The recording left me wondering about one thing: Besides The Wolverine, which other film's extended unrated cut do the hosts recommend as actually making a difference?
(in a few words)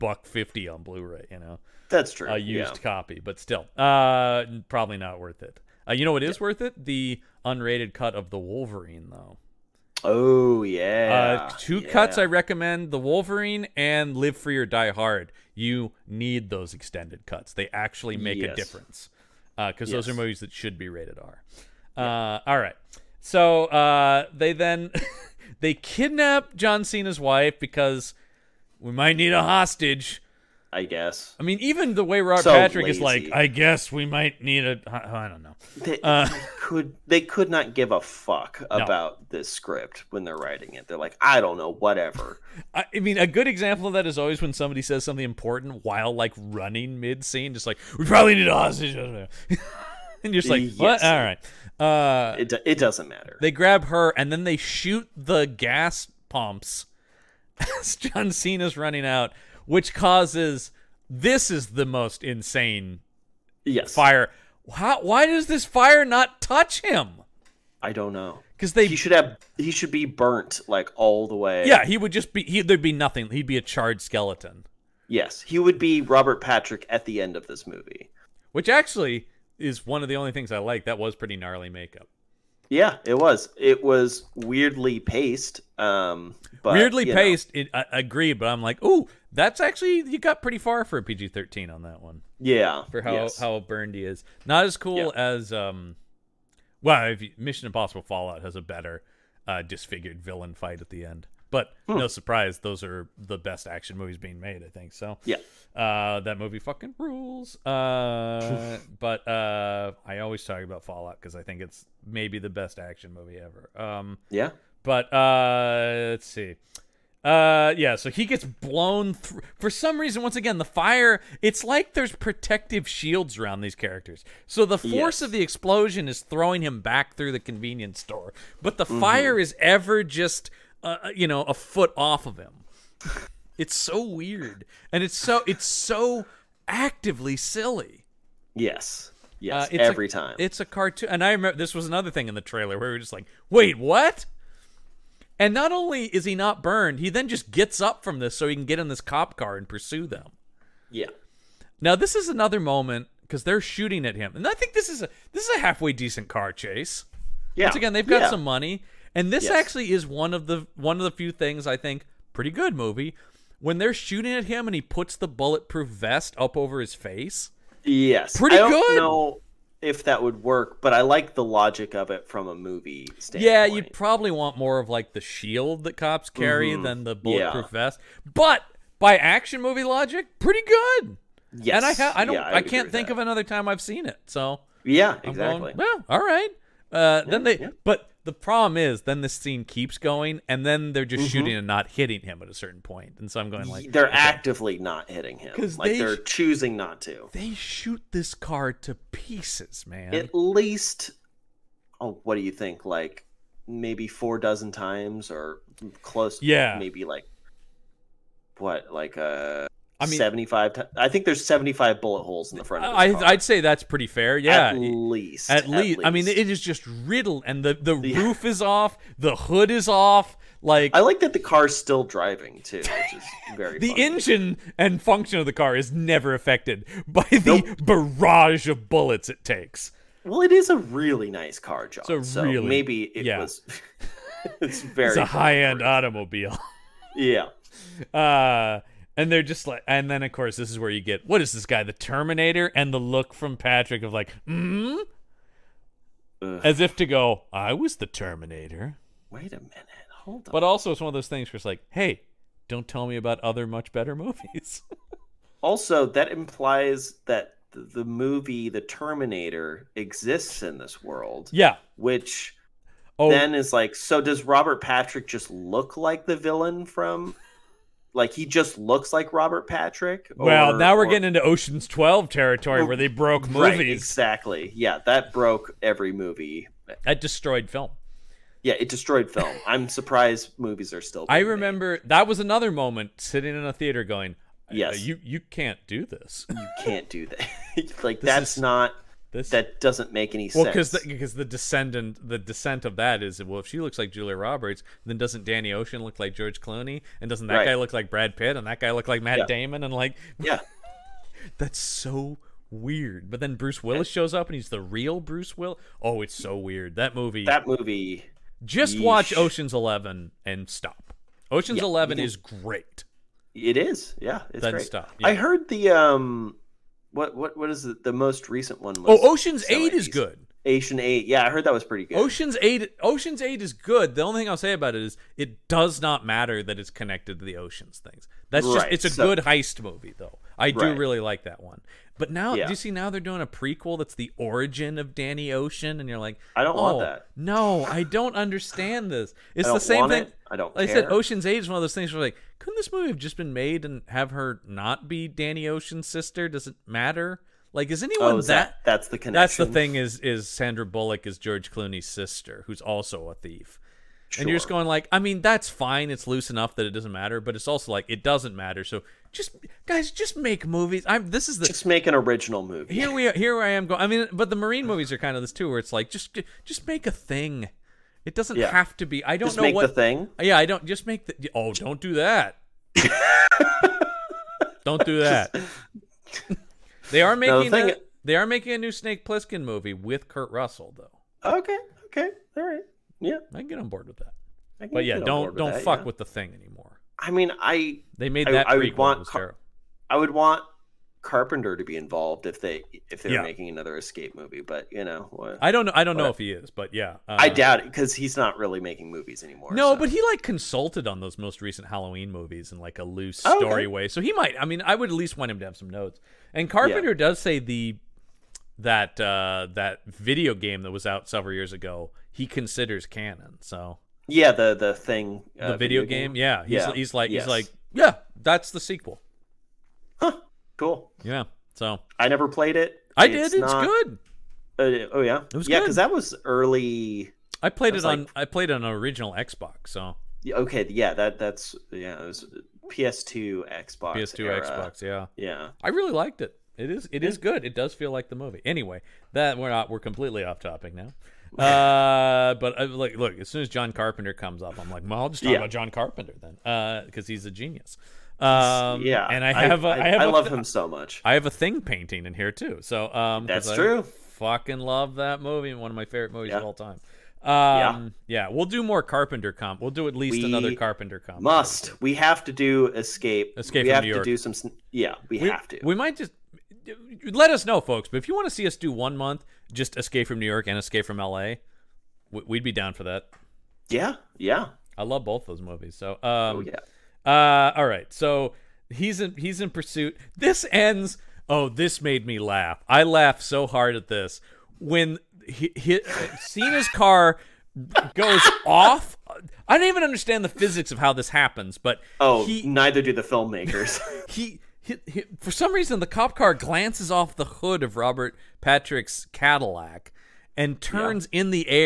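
Live Free or Die Hard.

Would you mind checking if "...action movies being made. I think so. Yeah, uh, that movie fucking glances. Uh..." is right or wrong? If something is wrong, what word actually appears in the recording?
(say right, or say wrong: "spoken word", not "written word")
wrong: "rules", not "glances".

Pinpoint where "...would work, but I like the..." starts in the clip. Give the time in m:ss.
2:50.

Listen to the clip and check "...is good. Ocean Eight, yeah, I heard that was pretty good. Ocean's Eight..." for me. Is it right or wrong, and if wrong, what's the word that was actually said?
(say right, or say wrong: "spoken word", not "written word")
right.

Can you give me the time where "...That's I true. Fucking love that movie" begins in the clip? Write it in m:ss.
7:33.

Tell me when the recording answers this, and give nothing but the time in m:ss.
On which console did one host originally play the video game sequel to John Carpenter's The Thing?
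7:08.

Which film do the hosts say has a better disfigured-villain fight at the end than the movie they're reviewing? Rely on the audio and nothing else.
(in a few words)
Mission Impossible Fallout.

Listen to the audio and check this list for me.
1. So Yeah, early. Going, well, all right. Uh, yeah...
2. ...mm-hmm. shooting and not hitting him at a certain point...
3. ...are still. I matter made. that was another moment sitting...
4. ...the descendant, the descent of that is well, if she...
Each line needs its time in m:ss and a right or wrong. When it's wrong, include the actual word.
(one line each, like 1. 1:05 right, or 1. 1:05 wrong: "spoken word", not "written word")
1. 3:04 wrong: "exactly", not "early"
2. 3:11 right
3. 4:40 wrong: "remember", not "matter"
4. 4:51 right.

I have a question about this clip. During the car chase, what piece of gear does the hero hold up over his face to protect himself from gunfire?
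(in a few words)
bulletproof vest.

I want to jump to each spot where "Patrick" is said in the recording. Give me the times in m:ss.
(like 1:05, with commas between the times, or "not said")
0:32, 1:16, 4:03, 4:24, 4:29, 8:18.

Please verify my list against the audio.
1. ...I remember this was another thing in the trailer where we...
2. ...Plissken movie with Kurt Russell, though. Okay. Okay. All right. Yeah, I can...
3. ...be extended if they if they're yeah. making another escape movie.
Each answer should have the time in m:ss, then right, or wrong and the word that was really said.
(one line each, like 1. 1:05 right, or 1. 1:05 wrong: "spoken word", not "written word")
1. 2:21 right
2. 6:19 right
3. 6:31 wrong: "involved", not "extended".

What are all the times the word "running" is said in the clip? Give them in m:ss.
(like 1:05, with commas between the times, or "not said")
0:46, 0:58.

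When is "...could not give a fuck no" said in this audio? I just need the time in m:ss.
0:37.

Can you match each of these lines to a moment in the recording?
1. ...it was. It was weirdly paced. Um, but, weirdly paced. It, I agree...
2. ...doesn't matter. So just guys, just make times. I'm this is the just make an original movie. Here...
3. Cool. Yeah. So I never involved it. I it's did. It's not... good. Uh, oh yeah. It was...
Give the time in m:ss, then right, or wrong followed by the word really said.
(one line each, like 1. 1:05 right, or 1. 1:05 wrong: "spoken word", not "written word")
1. 1:23 right
2. 5:58 wrong: "movies", not "times"
3. 7:00 wrong: "played", not "involved".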